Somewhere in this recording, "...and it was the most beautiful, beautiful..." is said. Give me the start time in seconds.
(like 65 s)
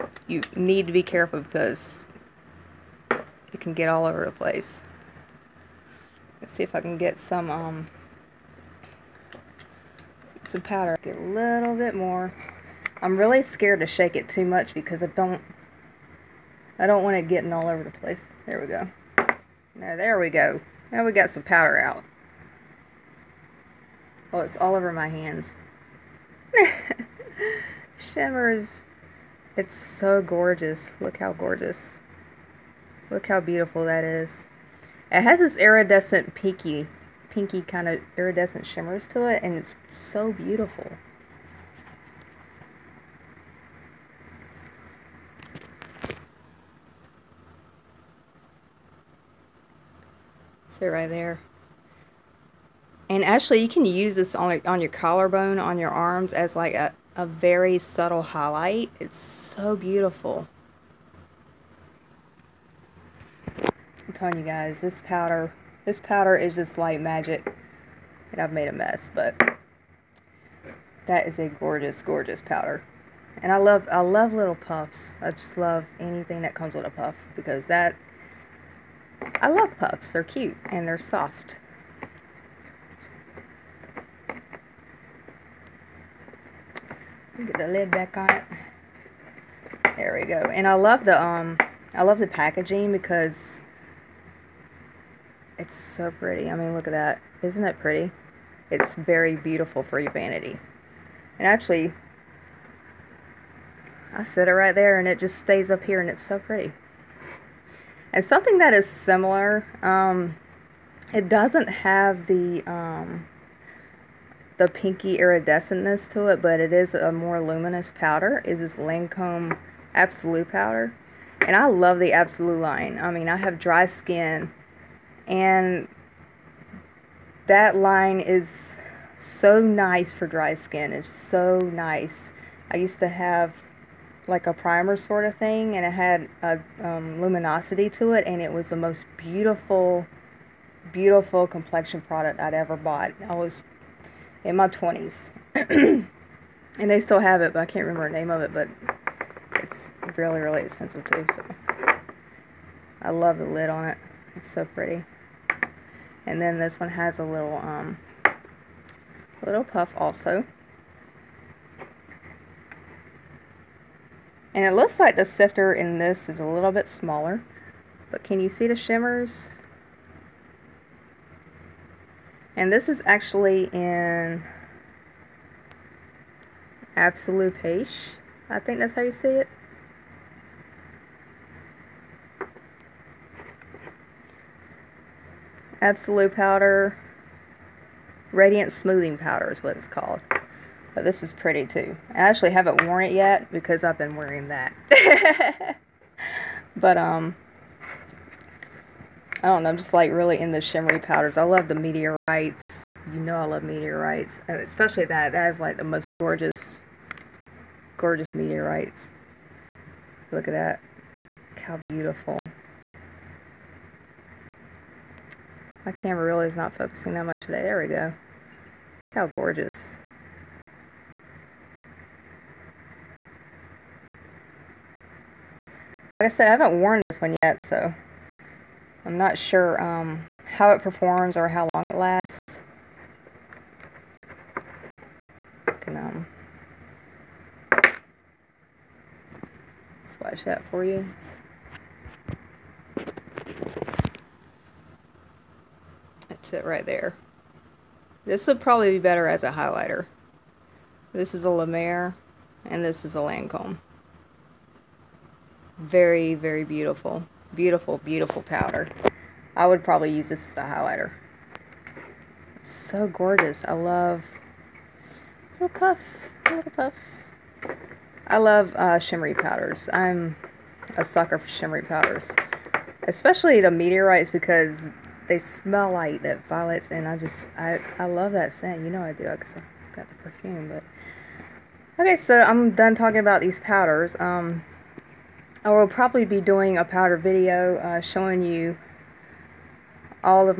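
138 s.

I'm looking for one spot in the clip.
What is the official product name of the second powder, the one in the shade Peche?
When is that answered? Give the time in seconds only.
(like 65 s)
188 s.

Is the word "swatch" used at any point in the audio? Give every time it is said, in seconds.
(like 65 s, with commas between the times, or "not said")
240 s.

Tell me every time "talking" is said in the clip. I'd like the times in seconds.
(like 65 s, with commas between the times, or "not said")
282 s.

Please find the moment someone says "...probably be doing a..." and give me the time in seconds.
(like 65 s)
285 s.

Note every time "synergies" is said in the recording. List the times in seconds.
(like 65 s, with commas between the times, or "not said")
not said.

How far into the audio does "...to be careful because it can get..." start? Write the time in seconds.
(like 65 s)
0 s.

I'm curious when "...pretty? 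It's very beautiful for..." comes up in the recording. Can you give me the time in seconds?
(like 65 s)
97 s.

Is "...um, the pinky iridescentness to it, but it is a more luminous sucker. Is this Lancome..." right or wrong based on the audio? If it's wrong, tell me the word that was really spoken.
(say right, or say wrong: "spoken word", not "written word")
wrong: "powder", not "sucker".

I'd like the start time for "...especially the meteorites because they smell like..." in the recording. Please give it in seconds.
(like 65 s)
273 s.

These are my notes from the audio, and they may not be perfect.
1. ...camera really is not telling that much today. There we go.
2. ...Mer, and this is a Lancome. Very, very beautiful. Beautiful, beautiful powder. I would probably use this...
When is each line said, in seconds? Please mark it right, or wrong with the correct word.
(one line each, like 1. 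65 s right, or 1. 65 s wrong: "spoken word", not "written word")
1. 215 s wrong: "focusing", not "telling"
2. 251 s right.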